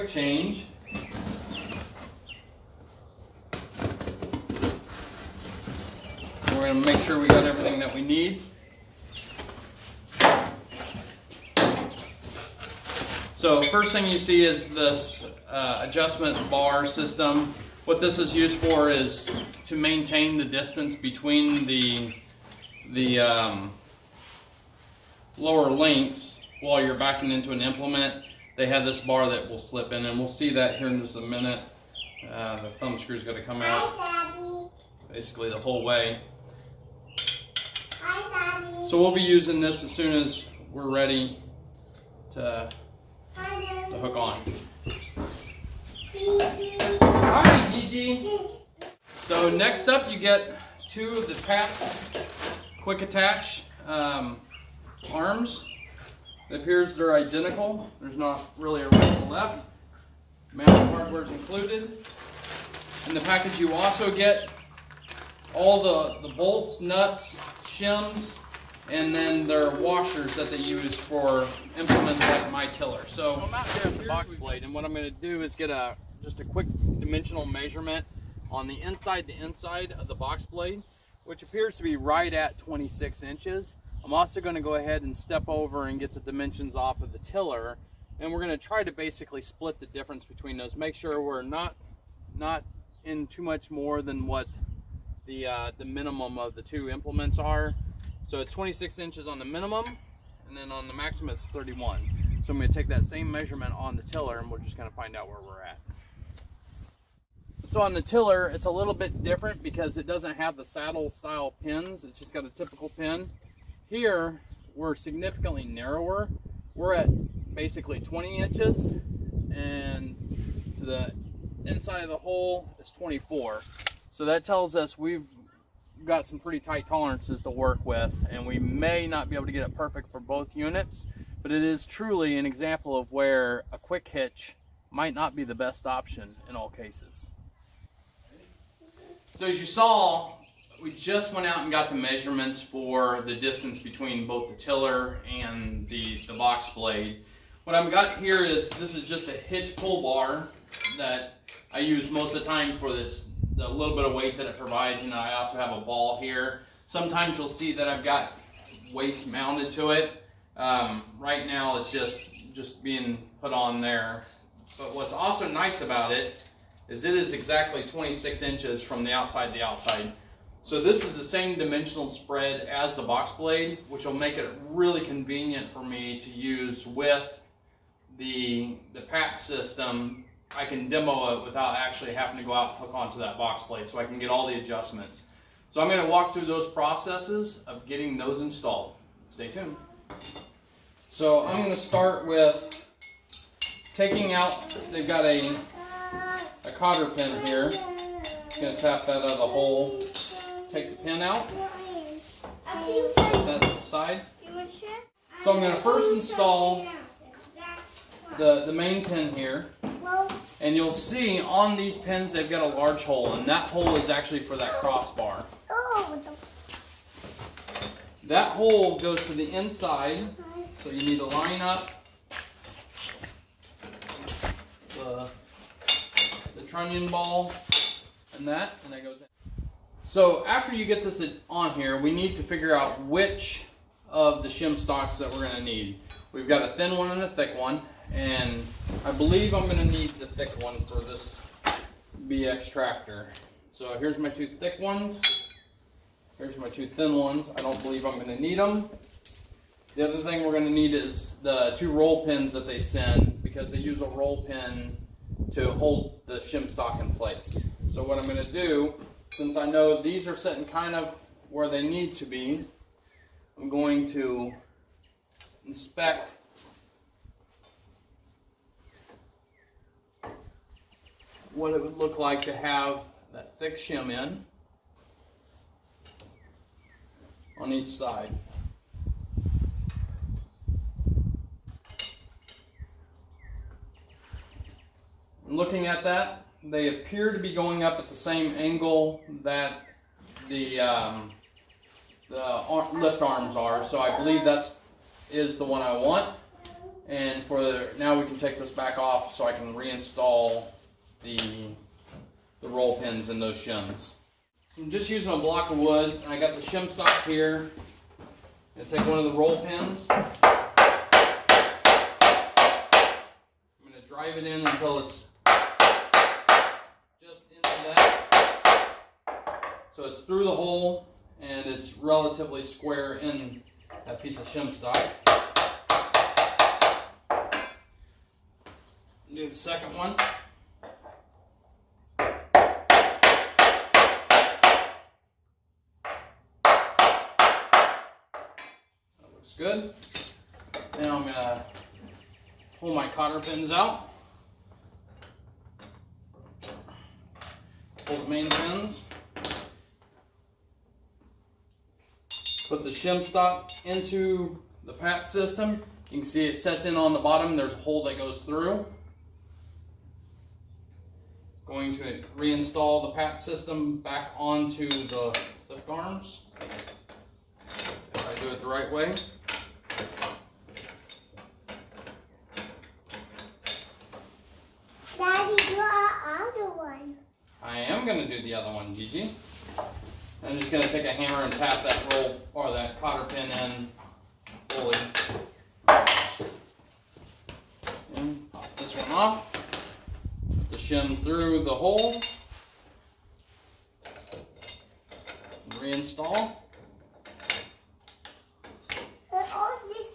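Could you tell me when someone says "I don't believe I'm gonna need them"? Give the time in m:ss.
4:07.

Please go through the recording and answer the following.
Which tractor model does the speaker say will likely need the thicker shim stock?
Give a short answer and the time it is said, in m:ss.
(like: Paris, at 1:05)
BX, at 4:02.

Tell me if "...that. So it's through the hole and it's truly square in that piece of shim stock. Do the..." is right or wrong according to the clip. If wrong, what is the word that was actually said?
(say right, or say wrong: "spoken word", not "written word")
wrong: "relatively", not "truly".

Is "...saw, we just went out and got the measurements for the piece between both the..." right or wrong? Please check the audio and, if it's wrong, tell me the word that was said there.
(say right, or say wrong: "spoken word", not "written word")
wrong: "distance", not "piece".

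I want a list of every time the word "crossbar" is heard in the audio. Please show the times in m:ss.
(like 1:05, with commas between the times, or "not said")
3:34.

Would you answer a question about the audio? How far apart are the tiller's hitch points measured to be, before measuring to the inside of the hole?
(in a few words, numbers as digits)
20 inches.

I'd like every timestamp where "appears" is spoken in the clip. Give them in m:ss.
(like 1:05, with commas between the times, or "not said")
0:56, 1:21, 4:46.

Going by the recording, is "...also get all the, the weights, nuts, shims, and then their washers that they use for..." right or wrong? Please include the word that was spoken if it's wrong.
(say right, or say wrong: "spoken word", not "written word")
wrong: "bolts", not "weights".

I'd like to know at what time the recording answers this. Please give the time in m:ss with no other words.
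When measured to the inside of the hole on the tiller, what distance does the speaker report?
2:02.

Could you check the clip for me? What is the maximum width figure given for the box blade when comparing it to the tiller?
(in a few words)
31.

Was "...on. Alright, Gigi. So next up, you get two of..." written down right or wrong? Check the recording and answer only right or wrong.
right.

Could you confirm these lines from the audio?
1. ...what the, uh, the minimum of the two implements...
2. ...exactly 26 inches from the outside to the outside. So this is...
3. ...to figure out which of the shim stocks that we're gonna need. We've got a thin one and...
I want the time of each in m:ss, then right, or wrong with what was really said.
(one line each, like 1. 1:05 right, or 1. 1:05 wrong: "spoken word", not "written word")
1. 1:34 right
2. 2:47 right
3. 3:52 right.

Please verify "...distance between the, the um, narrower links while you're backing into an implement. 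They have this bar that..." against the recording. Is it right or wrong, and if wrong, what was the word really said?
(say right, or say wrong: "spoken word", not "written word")
wrong: "lower", not "narrower".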